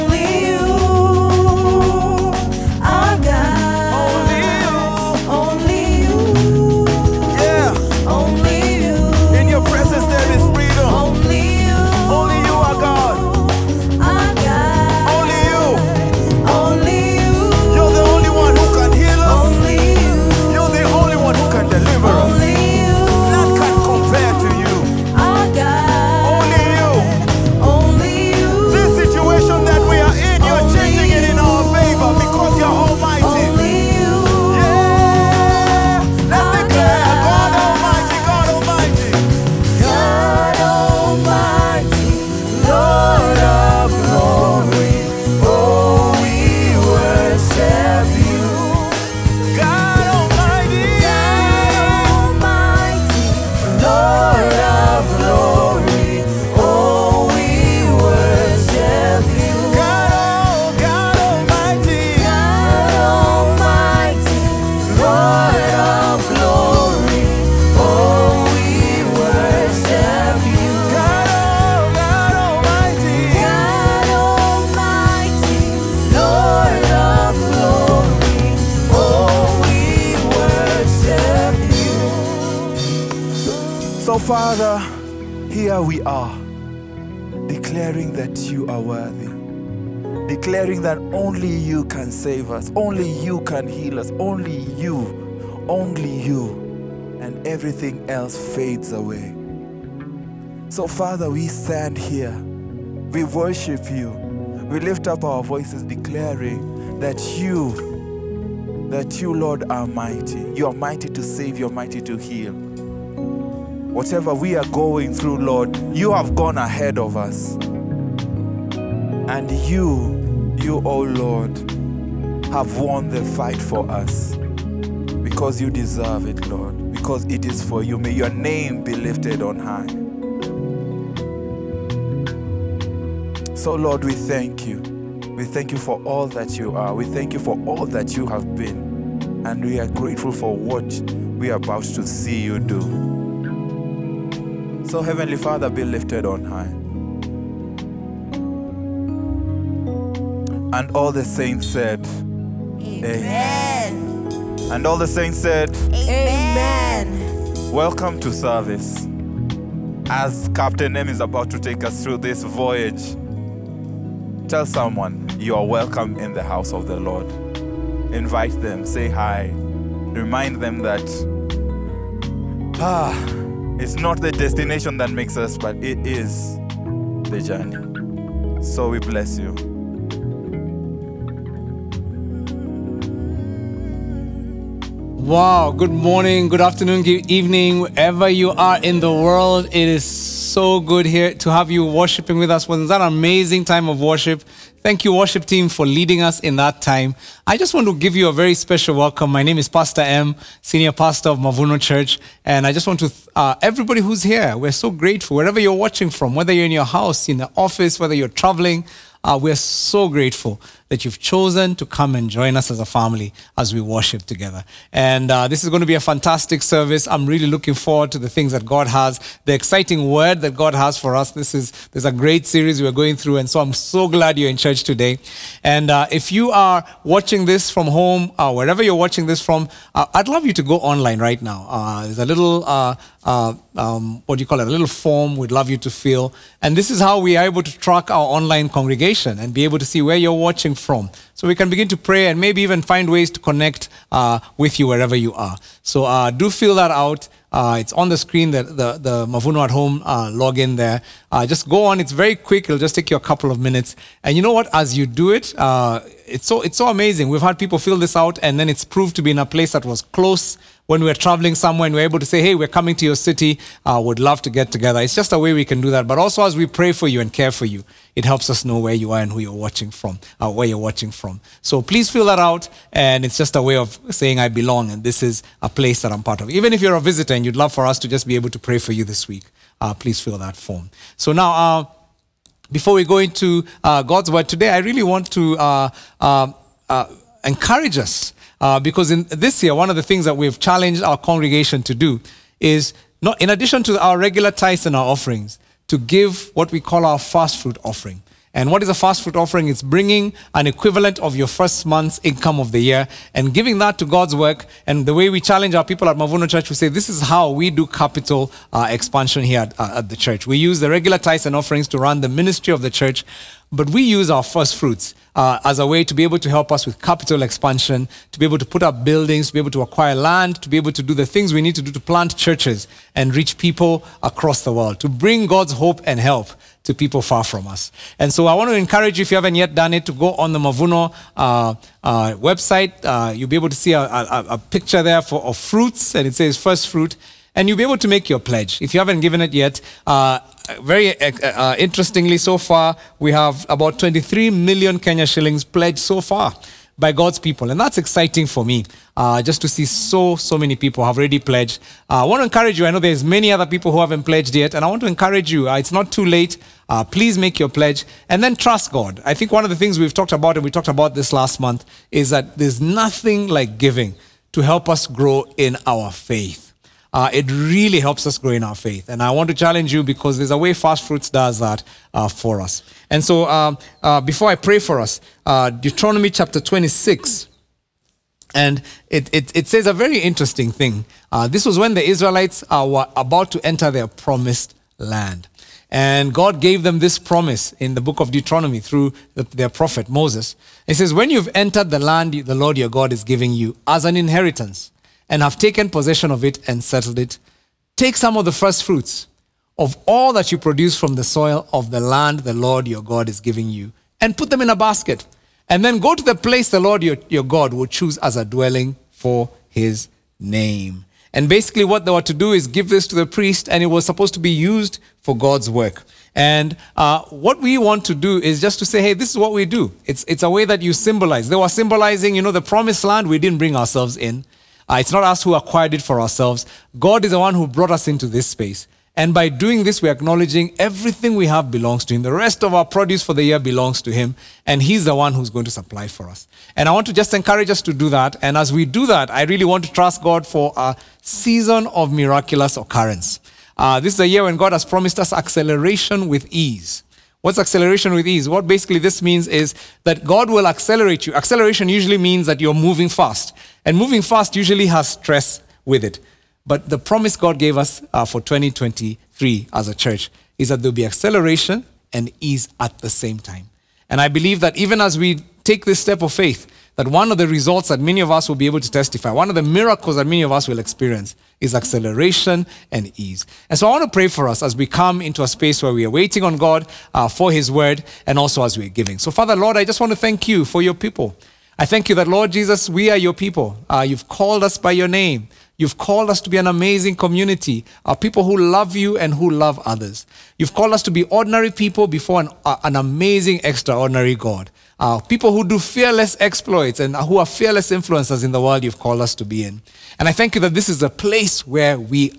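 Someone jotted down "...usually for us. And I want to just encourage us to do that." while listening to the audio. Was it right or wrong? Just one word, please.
wrong.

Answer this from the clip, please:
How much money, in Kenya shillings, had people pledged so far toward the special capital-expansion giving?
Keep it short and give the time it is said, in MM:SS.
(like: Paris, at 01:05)
23 million, at 05:43.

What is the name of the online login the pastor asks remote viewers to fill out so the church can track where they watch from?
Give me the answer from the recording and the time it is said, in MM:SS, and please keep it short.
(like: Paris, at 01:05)
Mavuno at Home, at 04:09.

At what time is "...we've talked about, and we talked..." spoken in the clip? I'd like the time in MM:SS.
05:59.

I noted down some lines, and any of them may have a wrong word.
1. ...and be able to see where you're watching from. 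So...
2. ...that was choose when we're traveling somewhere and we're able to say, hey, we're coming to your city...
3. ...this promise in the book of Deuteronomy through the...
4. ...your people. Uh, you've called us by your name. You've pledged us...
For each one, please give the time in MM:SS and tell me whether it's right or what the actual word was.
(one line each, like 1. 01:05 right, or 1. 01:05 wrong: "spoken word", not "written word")
1. 03:59 right
2. 04:19 wrong: "close", not "choose"
3. 06:26 right
4. 08:03 wrong: "called", not "pledged".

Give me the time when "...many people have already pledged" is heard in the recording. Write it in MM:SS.
05:50.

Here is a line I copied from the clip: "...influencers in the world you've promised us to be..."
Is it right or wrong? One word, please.
wrong.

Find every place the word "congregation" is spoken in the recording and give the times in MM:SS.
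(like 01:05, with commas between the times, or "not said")
03:58, 04:51.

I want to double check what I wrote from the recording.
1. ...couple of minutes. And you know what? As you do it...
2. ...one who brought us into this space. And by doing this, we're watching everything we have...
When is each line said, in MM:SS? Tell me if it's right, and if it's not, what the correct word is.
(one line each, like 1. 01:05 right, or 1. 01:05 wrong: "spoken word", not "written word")
1. 04:13 right
2. 07:07 wrong: "acknowledging", not "watching".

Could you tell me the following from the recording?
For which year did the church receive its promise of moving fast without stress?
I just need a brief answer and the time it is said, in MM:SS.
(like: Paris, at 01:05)
2023, at 07:38.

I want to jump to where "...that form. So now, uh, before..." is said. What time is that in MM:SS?
04:40.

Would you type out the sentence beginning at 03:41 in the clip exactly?
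This is there's a great series we're going through, and so I'm so glad you're in church today.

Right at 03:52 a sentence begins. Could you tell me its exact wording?
Uh, uh, um, what do you call it, a little form we'd love you to fill.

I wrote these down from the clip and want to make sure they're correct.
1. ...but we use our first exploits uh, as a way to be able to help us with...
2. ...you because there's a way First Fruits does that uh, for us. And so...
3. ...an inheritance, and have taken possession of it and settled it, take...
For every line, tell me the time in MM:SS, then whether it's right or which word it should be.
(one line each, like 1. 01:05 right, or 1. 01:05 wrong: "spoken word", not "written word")
1. 05:13 wrong: "fruits", not "exploits"
2. 06:09 right
3. 06:34 right.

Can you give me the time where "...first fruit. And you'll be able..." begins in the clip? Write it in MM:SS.
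05:36.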